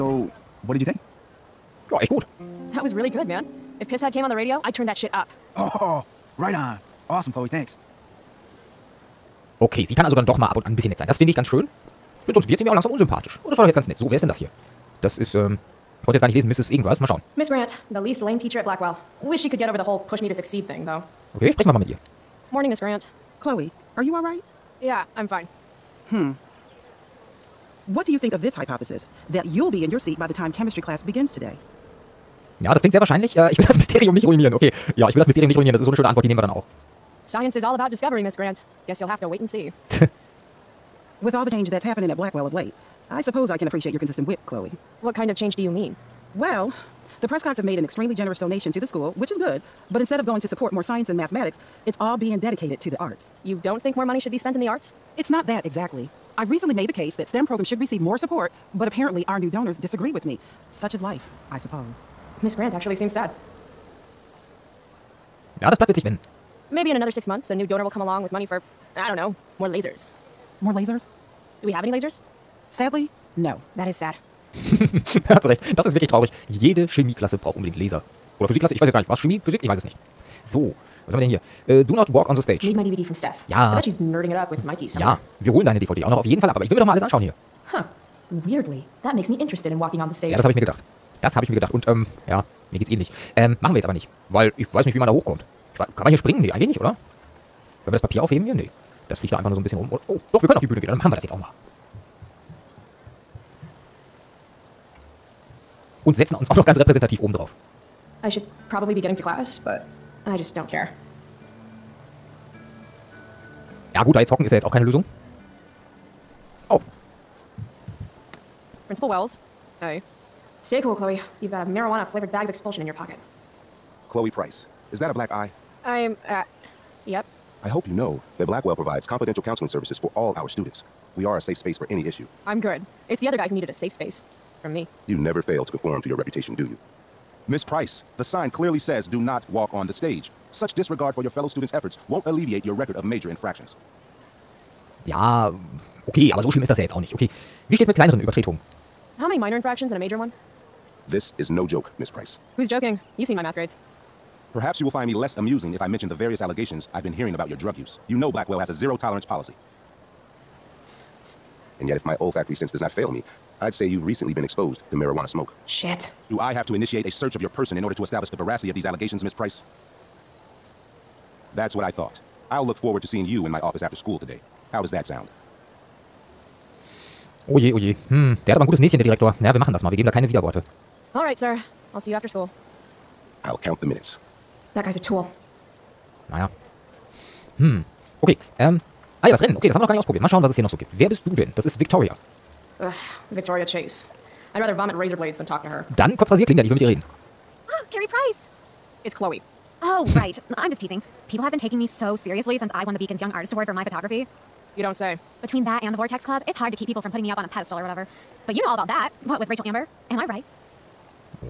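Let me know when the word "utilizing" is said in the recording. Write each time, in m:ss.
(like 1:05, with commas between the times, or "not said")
not said.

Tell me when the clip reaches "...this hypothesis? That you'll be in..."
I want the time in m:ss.
0:28.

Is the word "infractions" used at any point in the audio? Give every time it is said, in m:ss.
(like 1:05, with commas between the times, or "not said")
2:23, 2:29.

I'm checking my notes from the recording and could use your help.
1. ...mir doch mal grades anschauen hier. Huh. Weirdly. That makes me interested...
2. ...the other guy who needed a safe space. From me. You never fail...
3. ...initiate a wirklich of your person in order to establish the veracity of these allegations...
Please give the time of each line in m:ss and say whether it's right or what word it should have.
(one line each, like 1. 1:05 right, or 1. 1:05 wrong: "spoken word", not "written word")
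1. 1:26 wrong: "alles", not "grades"
2. 2:13 right
3. 2:46 wrong: "search", not "wirklich".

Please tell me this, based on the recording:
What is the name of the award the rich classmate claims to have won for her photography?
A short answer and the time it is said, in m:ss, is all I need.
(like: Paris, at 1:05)
Beacon's Young Artist Award, at 3:22.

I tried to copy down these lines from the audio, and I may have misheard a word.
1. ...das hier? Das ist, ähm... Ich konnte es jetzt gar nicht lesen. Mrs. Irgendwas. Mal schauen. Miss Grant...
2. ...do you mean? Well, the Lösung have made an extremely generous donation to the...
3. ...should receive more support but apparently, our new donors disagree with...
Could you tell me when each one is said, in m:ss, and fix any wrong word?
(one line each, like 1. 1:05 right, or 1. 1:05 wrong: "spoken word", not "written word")
1. 0:14 right
2. 0:45 wrong: "Prescotts", not "Lösung"
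3. 0:57 right.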